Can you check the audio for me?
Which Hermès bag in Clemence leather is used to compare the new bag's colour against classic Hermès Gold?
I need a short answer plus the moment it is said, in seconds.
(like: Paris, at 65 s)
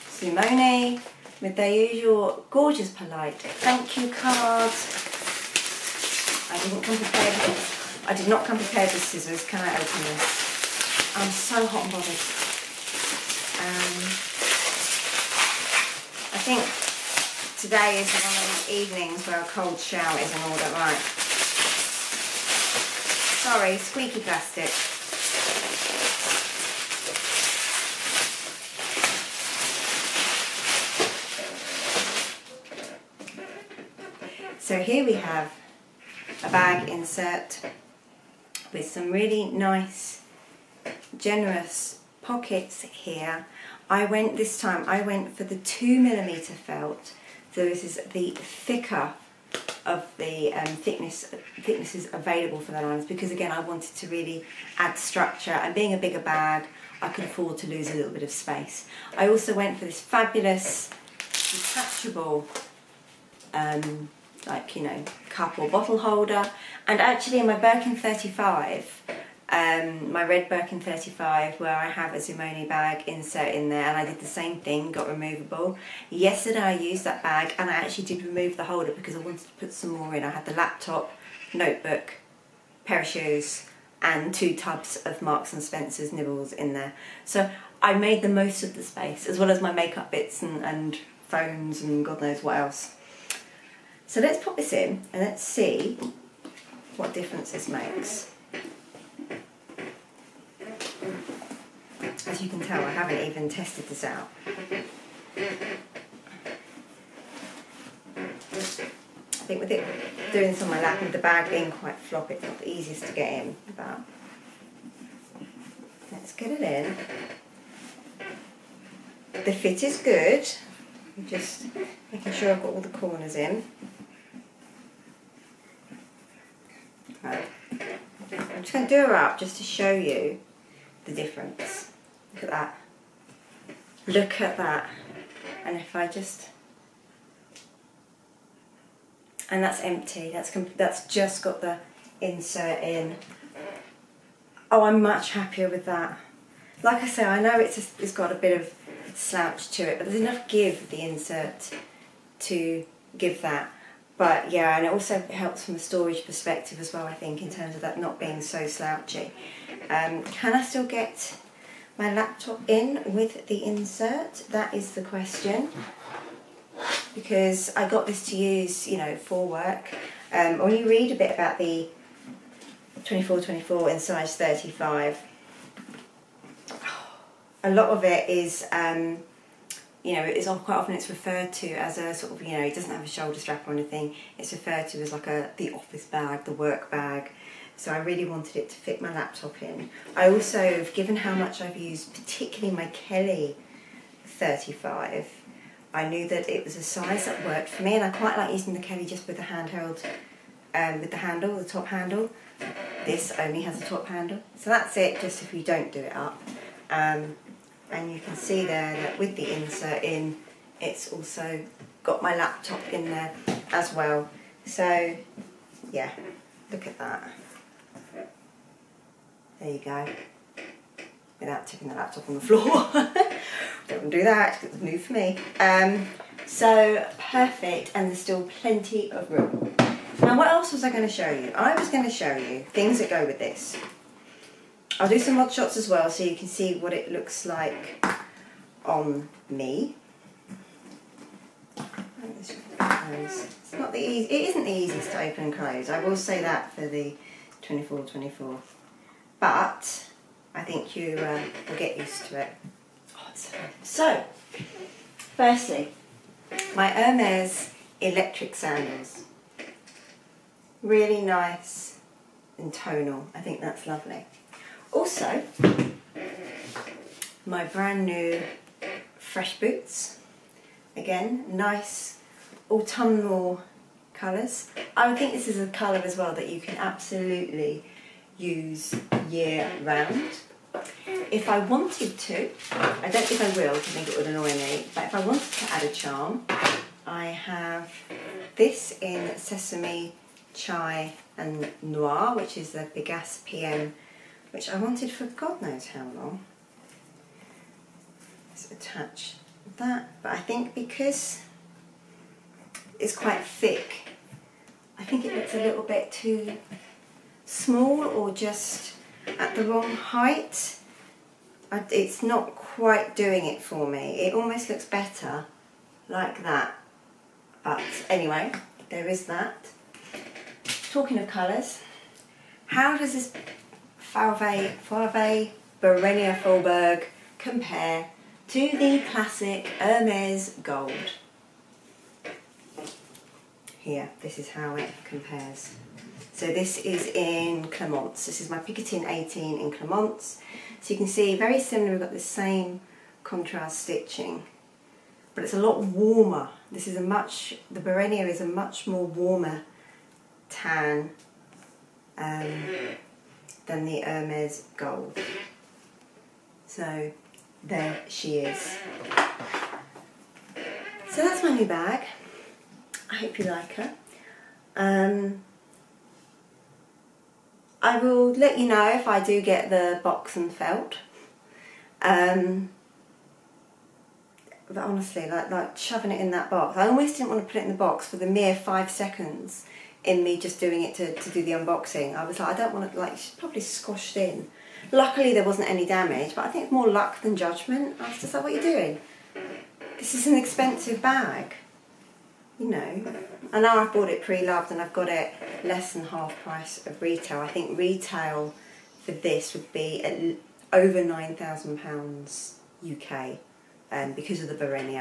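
Picotin 18, at 338 s.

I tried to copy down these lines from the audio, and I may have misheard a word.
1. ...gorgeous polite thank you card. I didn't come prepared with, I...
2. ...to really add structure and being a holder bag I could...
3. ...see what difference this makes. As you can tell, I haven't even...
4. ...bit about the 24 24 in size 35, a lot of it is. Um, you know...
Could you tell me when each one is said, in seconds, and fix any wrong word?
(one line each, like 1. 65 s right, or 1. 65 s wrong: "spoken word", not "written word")
1. 2 s right
2. 53 s wrong: "bigger", not "holder"
3. 95 s right
4. 171 s right.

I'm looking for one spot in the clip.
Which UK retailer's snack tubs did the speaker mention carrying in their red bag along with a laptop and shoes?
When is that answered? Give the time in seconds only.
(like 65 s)
85 s.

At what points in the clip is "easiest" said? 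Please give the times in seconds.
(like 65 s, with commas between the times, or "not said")
112 s, 244 s.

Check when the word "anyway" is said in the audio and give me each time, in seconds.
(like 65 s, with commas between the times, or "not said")
318 s.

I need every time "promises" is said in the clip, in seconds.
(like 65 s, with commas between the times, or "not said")
not said.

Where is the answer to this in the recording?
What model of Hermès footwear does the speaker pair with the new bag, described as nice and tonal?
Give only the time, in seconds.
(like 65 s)
257 s.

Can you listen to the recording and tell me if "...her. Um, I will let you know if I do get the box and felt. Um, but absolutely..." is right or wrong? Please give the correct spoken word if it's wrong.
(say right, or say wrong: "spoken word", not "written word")
wrong: "honestly", not "absolutely".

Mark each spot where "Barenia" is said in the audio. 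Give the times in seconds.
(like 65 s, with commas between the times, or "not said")
325 s, 347 s.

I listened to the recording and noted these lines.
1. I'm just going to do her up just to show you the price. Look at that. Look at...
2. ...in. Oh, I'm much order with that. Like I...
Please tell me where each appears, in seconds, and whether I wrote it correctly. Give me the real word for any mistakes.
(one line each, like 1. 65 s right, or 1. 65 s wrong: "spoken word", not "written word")
1. 127 s wrong: "difference", not "price"
2. 142 s wrong: "happier", not "order".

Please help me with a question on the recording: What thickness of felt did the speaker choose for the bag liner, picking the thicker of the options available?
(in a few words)
2mm.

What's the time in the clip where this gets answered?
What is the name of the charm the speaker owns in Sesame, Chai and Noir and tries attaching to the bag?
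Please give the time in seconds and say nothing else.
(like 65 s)
292 s.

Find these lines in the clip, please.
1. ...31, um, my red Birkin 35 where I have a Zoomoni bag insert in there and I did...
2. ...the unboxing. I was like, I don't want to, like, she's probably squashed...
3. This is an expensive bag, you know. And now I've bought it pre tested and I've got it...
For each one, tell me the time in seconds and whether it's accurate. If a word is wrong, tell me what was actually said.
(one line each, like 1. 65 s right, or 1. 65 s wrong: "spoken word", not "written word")
1. 67 s wrong: "35", not "31"
2. 381 s right
3. 389 s wrong: "loved", not "tested".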